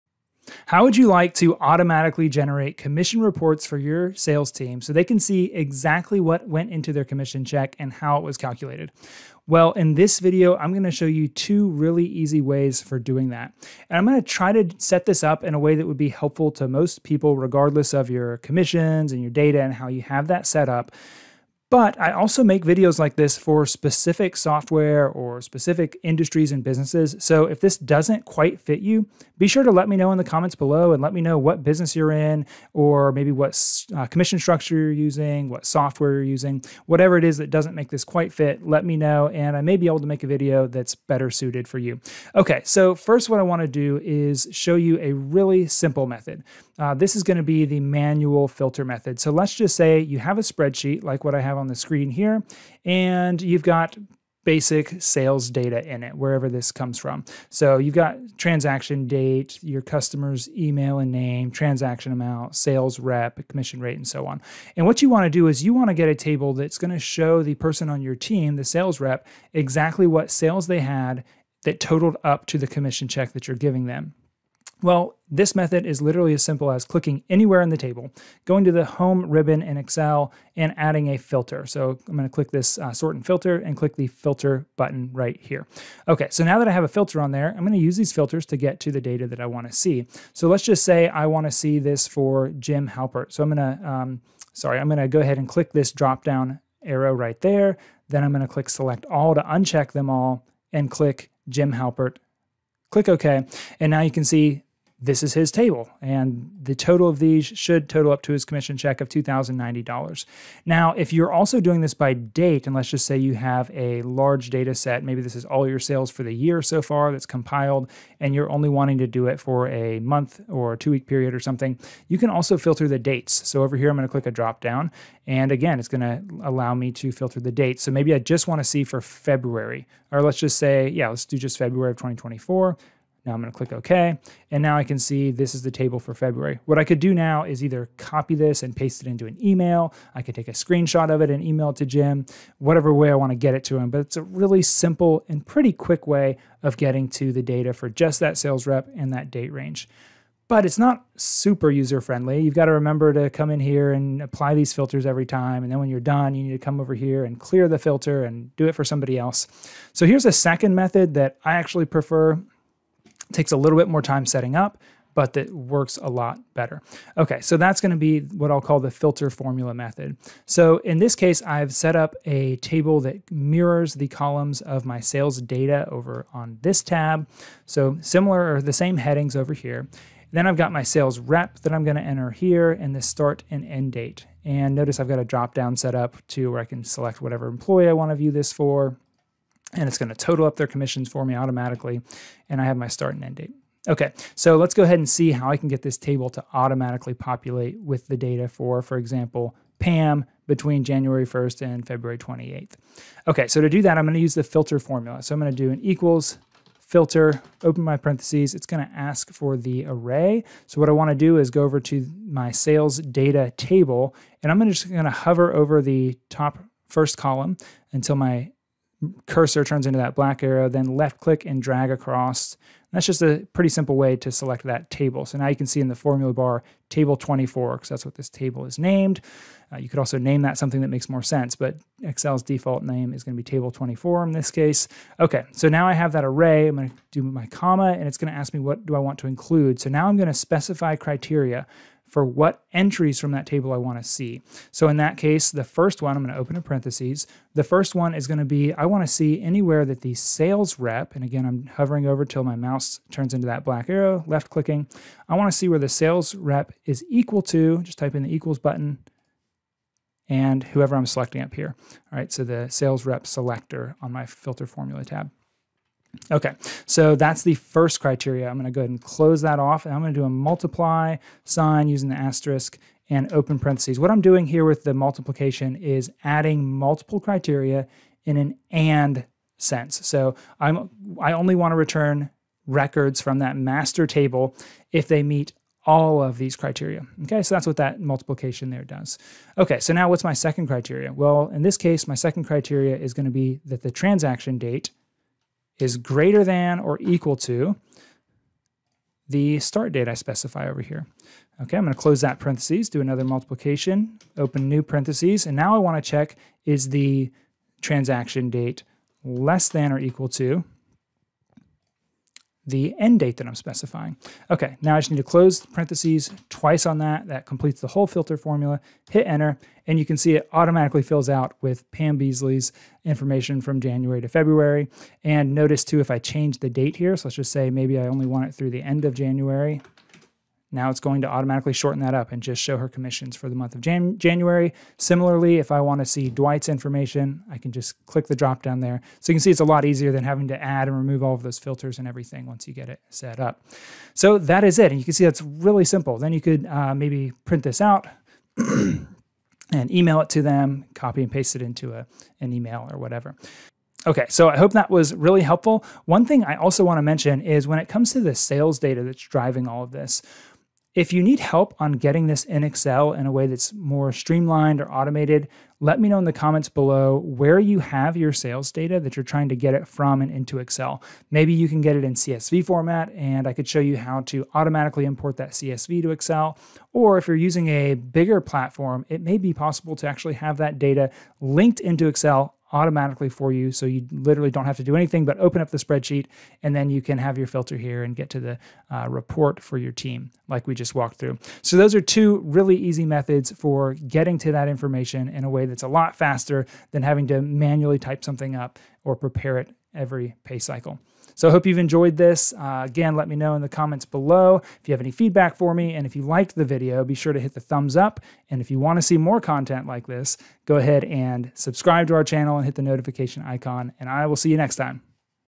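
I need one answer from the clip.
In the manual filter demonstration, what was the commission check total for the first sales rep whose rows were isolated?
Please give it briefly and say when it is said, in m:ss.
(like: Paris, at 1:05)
$2,090, at 1:49.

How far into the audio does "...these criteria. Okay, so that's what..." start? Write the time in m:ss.
4:46.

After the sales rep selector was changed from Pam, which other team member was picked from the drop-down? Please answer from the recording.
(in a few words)
Dwight.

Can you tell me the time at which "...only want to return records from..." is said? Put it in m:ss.
4:41.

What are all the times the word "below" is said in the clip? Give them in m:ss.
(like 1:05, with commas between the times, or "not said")
0:30, 6:06, 6:44.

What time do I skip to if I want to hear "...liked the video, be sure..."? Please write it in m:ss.
6:46.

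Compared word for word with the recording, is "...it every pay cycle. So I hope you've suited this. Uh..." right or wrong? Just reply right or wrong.
wrong.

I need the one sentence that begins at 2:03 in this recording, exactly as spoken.
So over here, I'm going to click a drop down.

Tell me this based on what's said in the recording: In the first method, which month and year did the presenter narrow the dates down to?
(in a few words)
February 2024.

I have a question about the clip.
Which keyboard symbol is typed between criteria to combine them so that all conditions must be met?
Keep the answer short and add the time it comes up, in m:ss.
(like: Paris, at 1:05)
asterisk, at 4:32.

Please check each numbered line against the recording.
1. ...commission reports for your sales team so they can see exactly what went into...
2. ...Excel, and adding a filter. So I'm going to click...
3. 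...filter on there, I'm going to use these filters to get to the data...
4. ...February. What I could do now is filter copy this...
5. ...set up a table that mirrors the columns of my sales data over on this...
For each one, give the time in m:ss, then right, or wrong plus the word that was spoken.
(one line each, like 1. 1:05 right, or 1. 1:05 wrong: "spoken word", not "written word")
1. 0:02 right
2. 1:19 right
3. 1:26 right
4. 2:16 wrong: "either", not "filter"
5. 2:51 right.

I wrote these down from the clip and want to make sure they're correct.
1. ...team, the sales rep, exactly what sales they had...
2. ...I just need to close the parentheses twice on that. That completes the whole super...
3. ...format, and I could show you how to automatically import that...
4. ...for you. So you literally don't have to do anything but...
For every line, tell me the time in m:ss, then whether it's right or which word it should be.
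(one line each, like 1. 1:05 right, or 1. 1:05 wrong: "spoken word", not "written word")
1. 1:08 right
2. 5:14 wrong: "filter", not "super"
3. 6:12 right
4. 6:23 right.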